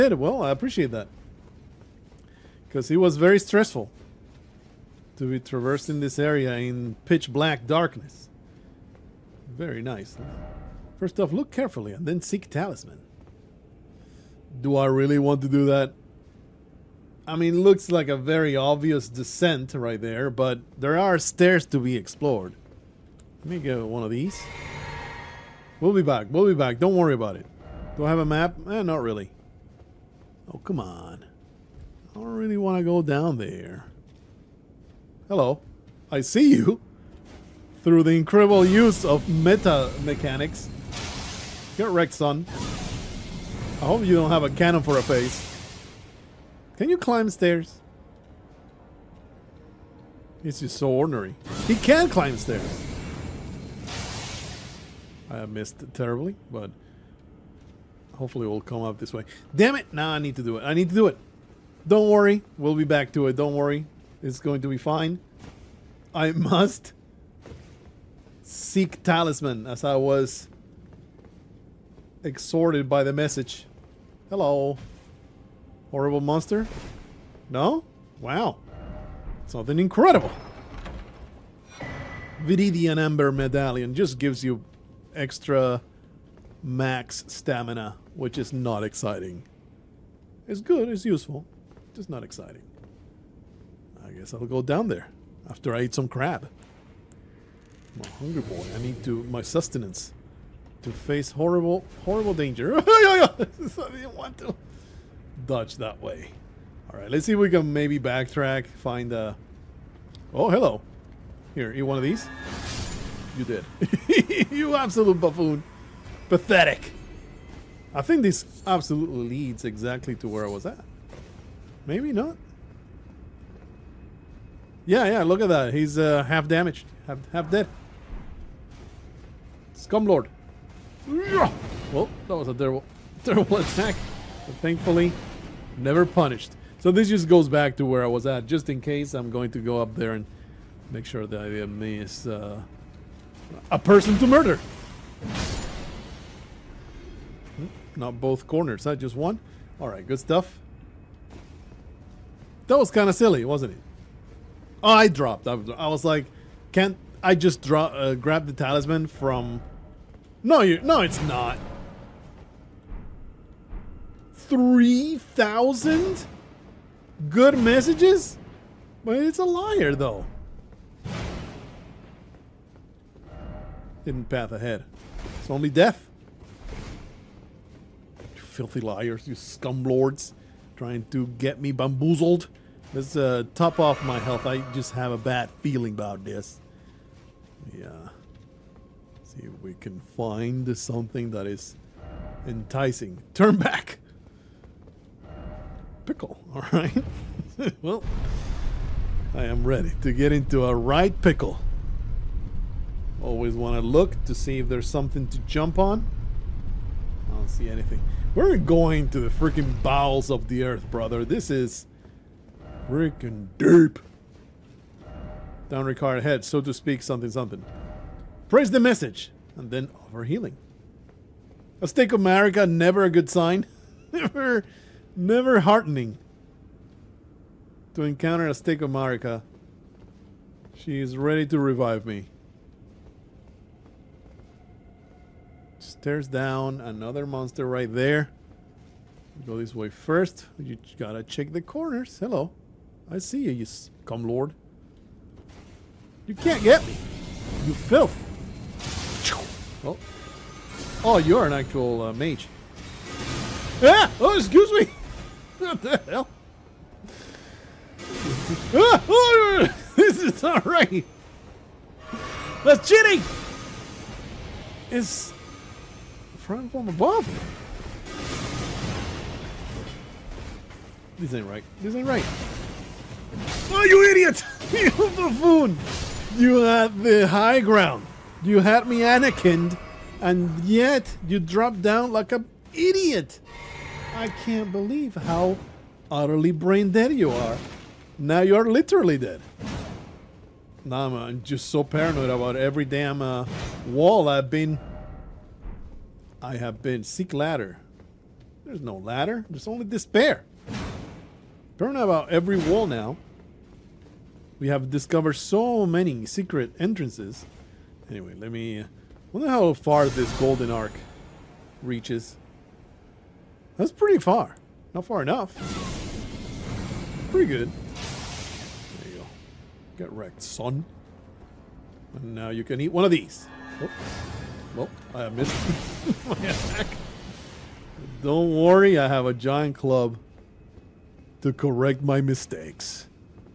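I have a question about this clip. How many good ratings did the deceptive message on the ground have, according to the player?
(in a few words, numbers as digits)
3000.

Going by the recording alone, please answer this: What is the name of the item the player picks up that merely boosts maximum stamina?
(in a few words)
Viridian Amber Medallion.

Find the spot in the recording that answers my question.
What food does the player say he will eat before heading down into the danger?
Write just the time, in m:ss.
1:36.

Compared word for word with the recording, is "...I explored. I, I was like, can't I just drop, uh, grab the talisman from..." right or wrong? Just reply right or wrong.
wrong.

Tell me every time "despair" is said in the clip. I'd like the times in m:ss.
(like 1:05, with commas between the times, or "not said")
4:59.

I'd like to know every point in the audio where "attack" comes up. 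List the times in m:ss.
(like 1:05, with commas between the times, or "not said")
2:13, 5:26.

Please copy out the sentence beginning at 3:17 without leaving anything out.
well, I am ready to get into a right pickle.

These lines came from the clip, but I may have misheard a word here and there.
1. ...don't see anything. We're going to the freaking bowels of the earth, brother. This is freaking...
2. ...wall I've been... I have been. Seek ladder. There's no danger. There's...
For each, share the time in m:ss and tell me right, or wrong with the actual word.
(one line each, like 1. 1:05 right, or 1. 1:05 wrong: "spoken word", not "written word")
1. 3:27 right
2. 4:53 wrong: "ladder", not "danger".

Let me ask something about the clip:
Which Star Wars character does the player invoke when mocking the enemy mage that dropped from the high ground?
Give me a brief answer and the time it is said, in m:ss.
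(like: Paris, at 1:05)
Anakin, at 4:38.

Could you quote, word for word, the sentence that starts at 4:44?
I can't believe how utterly brain dead you are.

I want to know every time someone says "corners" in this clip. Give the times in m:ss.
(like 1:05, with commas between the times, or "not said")
2:28, 4:01.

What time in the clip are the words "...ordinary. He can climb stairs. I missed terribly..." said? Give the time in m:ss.
0:50.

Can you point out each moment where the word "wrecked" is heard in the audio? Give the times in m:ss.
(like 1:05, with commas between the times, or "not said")
0:41, 5:20.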